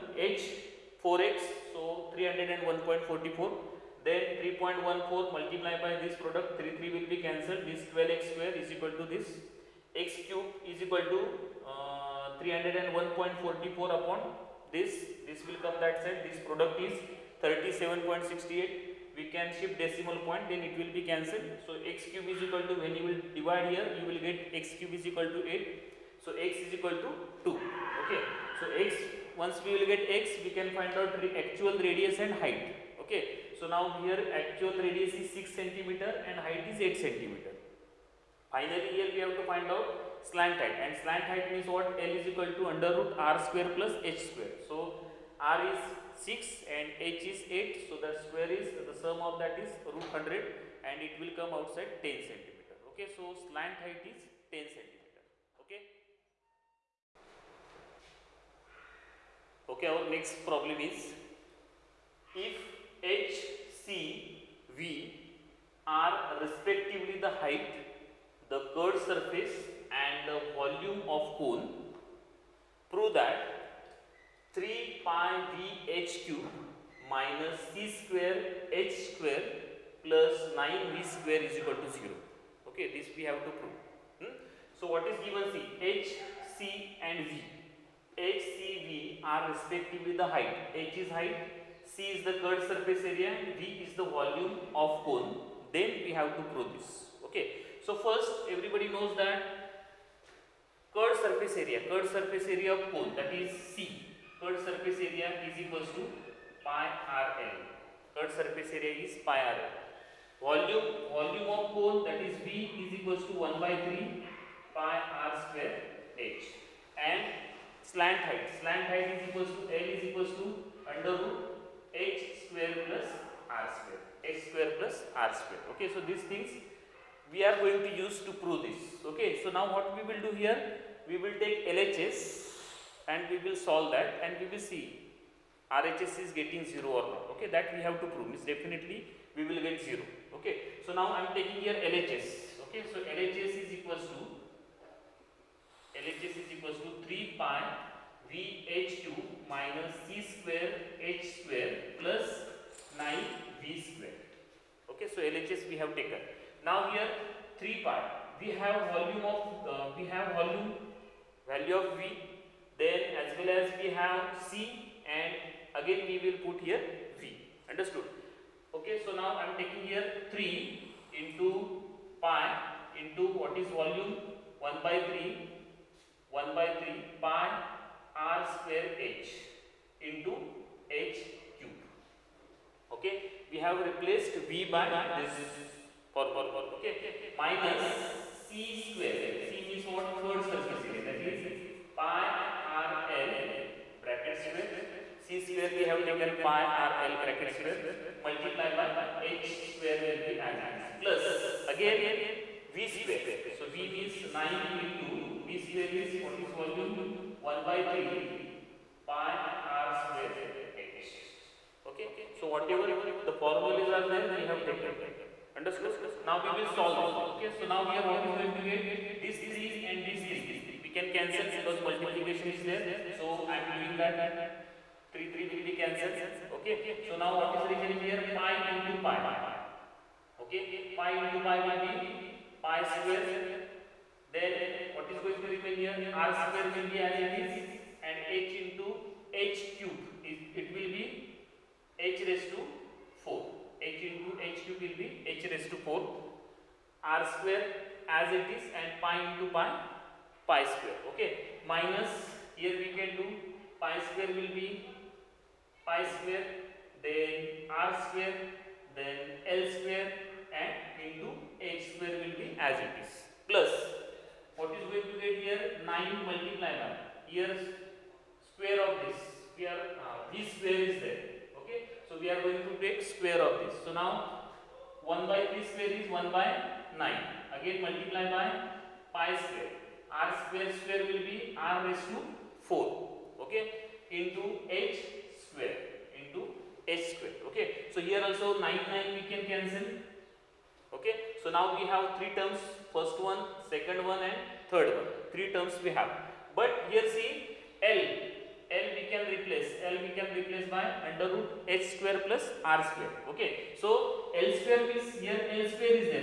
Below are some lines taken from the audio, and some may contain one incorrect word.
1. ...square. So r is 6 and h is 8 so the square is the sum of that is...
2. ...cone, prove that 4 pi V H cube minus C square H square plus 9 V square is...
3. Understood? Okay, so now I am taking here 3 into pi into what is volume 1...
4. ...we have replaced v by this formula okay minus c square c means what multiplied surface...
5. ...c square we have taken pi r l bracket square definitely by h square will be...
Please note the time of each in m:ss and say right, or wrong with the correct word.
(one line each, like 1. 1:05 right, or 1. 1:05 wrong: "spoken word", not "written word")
1. 0:44 right
2. 1:11 wrong: "3", not "4"
3. 2:47 right
4. 3:03 wrong: "curved", not "multiplied"
5. 3:15 wrong: "multiply", not "definitely".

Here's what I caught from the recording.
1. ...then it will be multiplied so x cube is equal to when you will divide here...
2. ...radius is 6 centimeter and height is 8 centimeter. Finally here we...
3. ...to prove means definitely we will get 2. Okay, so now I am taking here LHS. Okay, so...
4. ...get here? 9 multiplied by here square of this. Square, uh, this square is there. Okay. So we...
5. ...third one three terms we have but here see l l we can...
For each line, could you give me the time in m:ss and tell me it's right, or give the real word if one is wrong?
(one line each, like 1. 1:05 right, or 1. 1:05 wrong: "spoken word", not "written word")
1. 0:20 wrong: "cancelled", not "multiplied"
2. 0:34 right
3. 2:18 wrong: "0", not "2"
4. 4:25 right
5. 4:54 right.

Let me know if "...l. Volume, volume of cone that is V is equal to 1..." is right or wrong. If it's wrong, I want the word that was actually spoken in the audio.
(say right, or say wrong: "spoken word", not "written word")
right.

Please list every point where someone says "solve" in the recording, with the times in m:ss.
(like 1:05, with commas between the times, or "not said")
2:13, 3:36.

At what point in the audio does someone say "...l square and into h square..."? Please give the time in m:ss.
4:19.